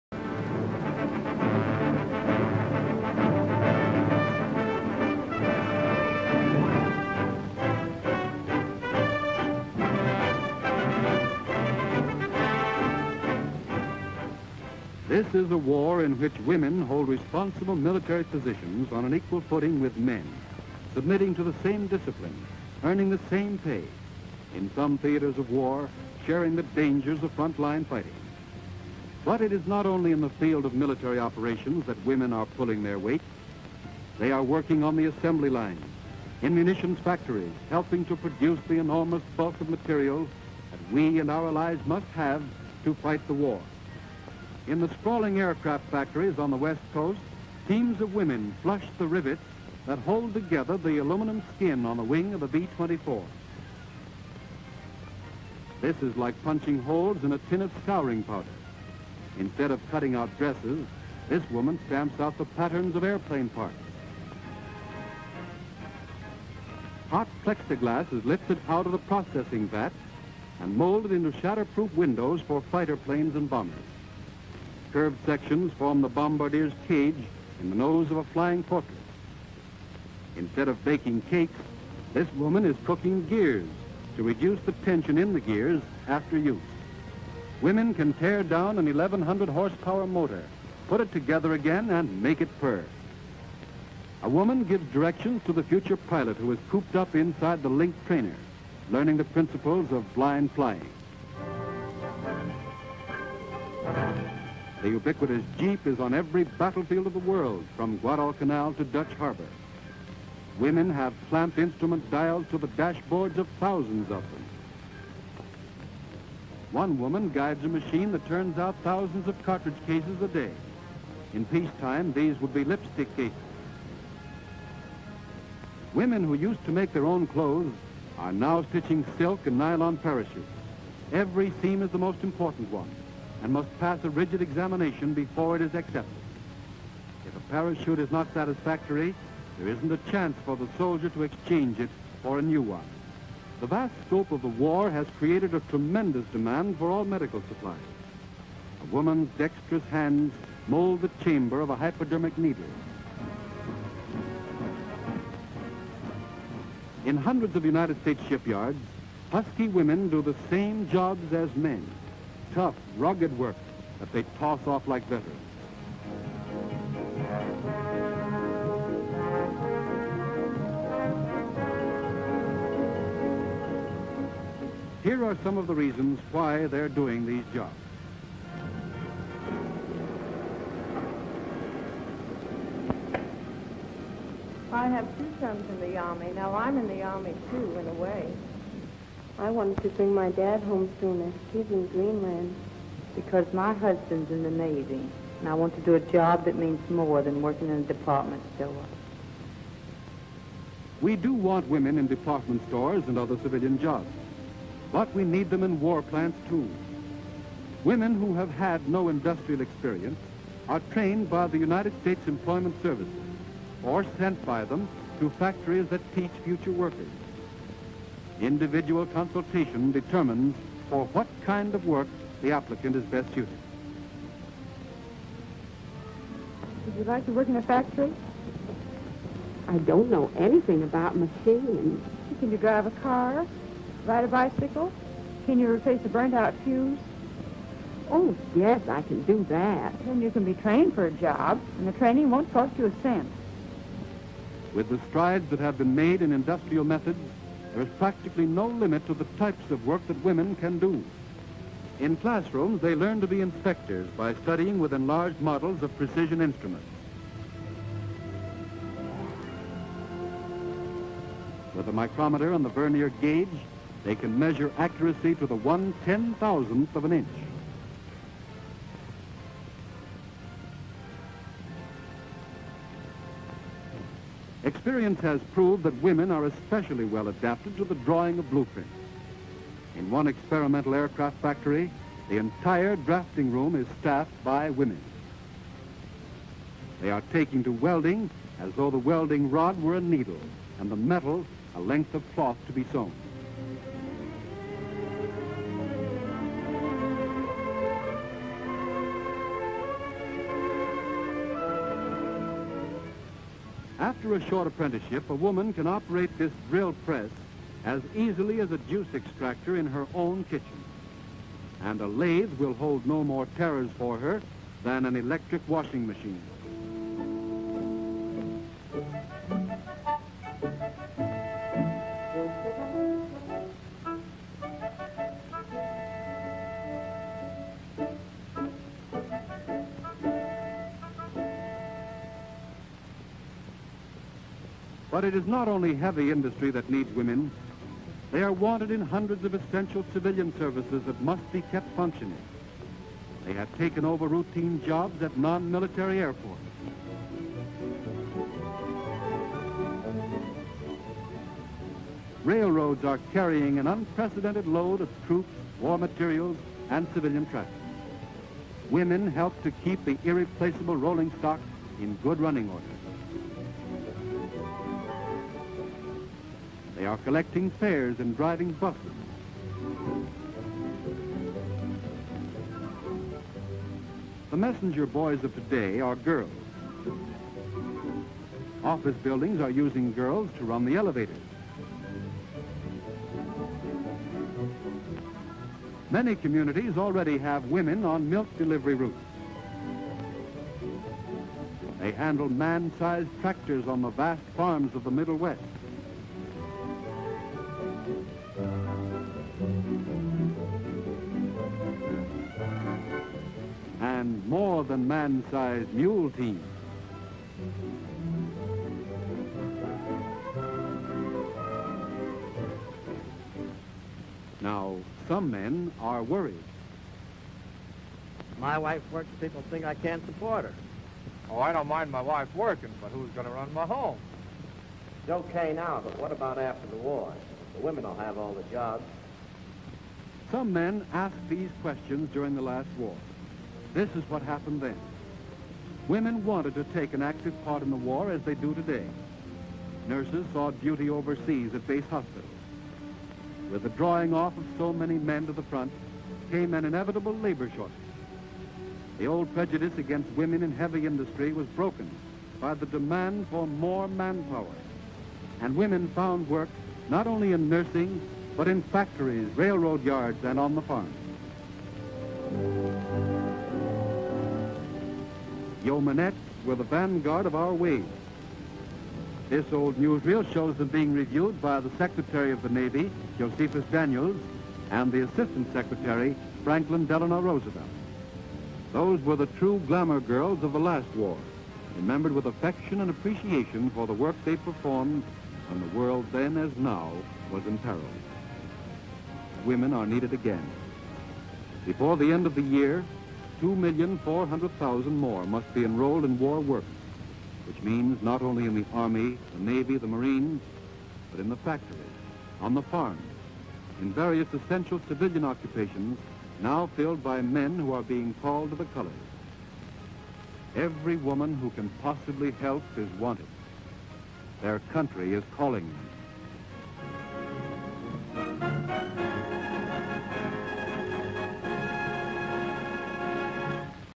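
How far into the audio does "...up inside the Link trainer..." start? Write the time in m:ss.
1:36.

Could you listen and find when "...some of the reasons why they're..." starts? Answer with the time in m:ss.
2:55.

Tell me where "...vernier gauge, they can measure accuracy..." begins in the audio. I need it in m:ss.
4:22.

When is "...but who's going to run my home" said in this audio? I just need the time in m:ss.
7:03.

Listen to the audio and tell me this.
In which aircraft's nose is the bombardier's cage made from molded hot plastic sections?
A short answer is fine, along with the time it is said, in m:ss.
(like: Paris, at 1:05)
Flying Fortress, at 1:18.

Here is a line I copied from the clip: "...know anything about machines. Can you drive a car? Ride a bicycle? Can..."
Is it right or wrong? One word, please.
right.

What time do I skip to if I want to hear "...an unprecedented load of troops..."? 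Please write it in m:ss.
5:53.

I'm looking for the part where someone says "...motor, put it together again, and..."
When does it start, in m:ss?
1:30.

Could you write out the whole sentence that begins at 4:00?
Then you can be trained for a job, and the training won't cost you a cent.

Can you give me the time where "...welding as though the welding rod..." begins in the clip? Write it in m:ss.
4:47.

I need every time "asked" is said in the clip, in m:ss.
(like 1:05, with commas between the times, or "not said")
7:11.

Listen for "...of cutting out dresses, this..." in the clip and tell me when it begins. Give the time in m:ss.
0:59.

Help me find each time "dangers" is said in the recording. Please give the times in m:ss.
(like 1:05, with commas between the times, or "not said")
0:26.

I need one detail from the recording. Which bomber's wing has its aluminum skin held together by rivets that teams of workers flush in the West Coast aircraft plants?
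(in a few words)
B-24.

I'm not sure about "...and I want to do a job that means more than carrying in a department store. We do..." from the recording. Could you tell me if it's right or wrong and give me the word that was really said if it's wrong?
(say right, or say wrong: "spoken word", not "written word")
wrong: "working", not "carrying".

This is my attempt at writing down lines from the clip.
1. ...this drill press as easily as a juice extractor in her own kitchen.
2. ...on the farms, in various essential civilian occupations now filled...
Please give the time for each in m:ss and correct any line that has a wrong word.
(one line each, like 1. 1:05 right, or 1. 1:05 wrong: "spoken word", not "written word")
1. 5:06 right
2. 8:22 right.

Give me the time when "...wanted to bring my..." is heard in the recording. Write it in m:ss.
3:09.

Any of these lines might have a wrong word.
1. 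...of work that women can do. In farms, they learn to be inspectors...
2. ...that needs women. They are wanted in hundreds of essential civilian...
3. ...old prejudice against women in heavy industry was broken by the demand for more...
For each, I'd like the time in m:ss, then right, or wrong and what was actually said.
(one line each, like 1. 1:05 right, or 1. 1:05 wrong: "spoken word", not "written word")
1. 4:09 wrong: "classrooms", not "farms"
2. 5:36 right
3. 7:29 right.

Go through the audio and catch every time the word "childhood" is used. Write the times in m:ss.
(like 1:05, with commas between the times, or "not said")
not said.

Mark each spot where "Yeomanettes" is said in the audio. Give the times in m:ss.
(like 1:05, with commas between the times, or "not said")
7:45.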